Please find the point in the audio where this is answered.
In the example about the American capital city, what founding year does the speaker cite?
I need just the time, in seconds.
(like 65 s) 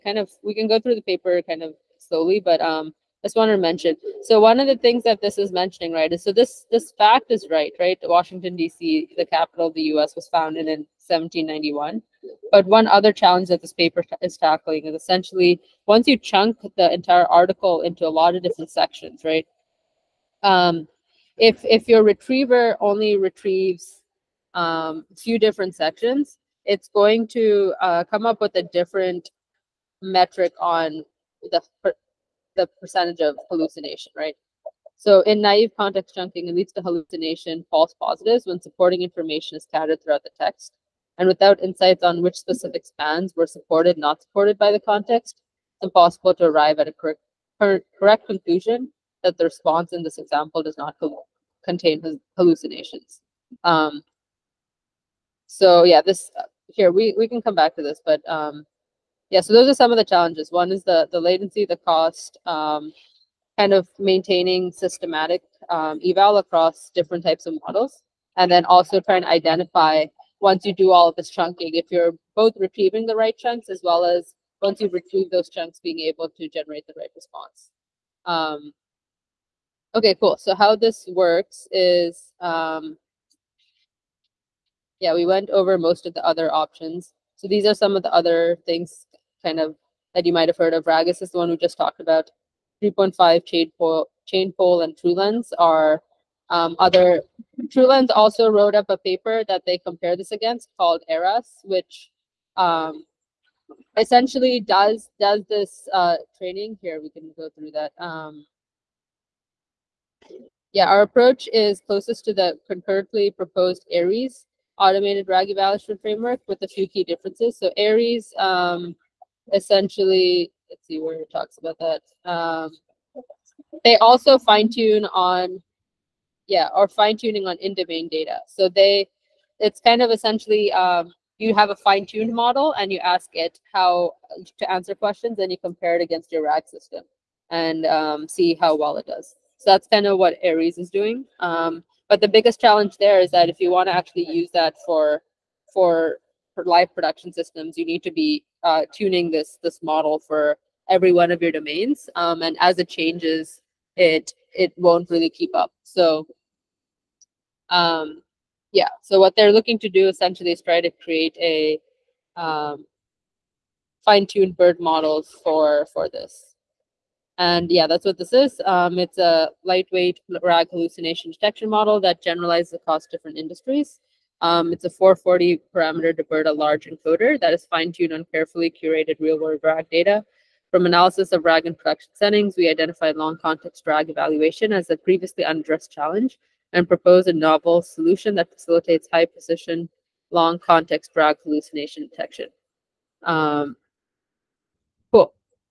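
11 s.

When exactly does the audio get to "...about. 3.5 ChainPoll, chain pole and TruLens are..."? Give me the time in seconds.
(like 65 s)
91 s.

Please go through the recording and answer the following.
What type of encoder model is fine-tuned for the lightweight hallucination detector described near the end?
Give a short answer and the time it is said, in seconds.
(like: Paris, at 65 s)
DeBERTa large, at 176 s.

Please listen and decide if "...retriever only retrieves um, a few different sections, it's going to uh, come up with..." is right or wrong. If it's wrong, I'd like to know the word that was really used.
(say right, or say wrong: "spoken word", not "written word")
right.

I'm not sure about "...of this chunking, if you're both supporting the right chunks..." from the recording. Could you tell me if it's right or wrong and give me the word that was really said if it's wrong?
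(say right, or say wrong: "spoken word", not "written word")
wrong: "retrieving", not "supporting".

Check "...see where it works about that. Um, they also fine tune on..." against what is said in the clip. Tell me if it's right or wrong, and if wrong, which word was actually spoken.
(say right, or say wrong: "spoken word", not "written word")
wrong: "talks", not "works".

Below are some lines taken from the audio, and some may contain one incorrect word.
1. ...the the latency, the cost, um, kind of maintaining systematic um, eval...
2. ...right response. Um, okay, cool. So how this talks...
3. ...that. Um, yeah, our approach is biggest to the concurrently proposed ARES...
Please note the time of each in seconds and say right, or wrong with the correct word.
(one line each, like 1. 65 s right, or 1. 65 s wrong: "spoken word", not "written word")
1. 60 s right
2. 76 s wrong: "works", not "talks"
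3. 107 s wrong: "closest", not "biggest".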